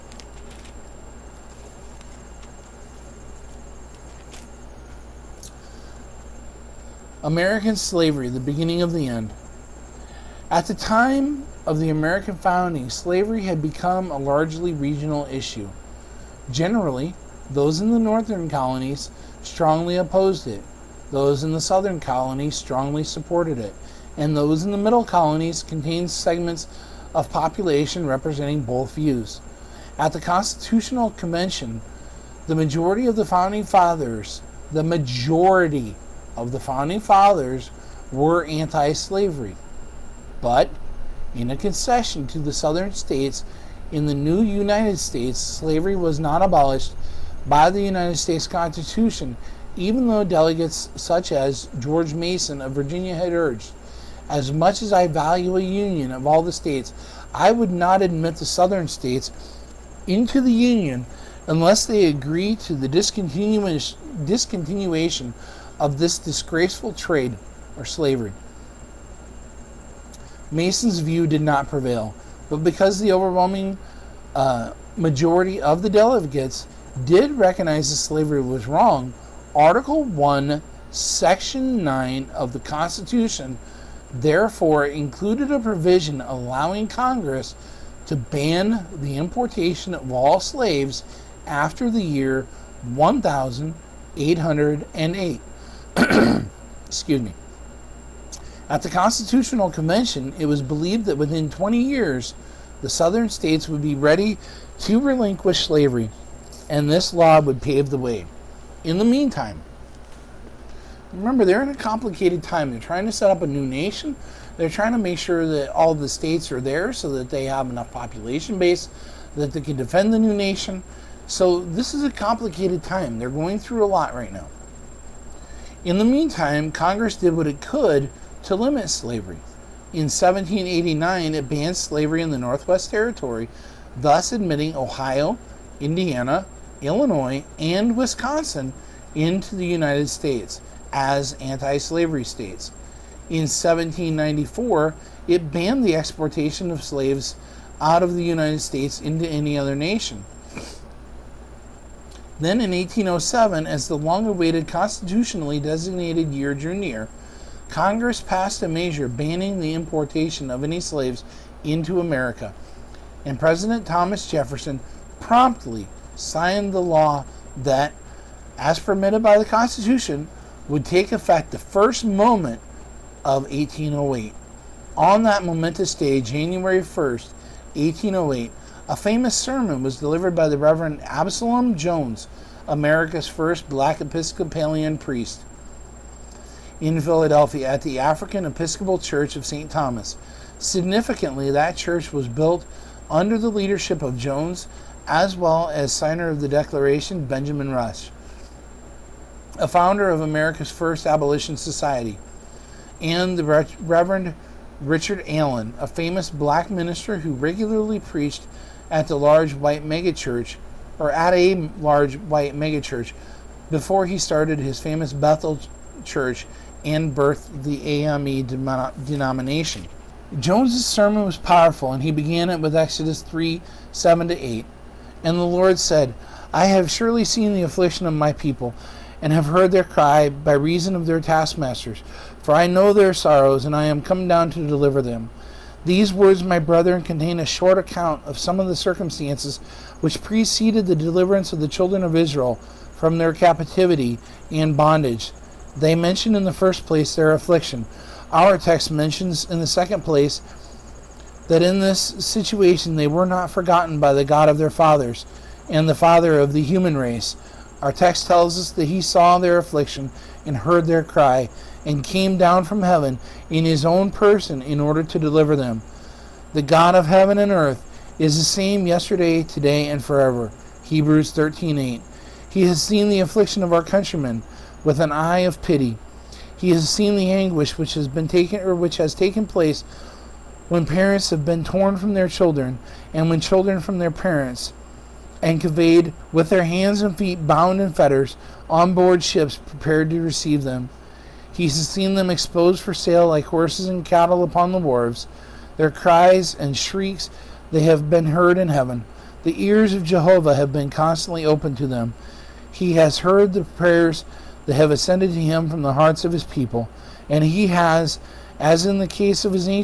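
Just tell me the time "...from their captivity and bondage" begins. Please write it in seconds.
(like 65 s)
242 s.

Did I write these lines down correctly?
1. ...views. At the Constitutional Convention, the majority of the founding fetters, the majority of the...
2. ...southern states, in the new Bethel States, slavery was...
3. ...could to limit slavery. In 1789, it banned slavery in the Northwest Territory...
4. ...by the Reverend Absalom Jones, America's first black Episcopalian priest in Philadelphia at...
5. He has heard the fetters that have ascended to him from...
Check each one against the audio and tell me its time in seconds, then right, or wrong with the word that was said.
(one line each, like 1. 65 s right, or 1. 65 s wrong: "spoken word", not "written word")
1. 28 s wrong: "fathers", not "fetters"
2. 42 s wrong: "United", not "Bethel"
3. 127 s right
4. 180 s right
5. 302 s wrong: "prayers", not "fetters".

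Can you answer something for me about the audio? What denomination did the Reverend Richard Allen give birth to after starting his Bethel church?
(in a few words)
AME.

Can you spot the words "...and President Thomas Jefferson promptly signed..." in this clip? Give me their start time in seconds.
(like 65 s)
163 s.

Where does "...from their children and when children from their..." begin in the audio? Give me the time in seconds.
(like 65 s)
281 s.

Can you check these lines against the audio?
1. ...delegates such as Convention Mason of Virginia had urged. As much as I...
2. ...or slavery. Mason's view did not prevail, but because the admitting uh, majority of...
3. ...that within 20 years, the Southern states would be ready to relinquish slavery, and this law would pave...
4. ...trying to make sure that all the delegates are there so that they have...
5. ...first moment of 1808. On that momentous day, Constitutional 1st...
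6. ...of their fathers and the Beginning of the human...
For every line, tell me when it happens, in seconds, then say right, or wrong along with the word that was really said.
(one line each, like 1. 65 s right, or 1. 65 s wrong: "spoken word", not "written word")
1. 50 s wrong: "George", not "Convention"
2. 67 s wrong: "overwhelming", not "admitting"
3. 101 s right
4. 114 s wrong: "states", not "delegates"
5. 171 s wrong: "January", not "Constitutional"
6. 254 s wrong: "Father", not "Beginning".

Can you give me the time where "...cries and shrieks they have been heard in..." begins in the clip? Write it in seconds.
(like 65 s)
295 s.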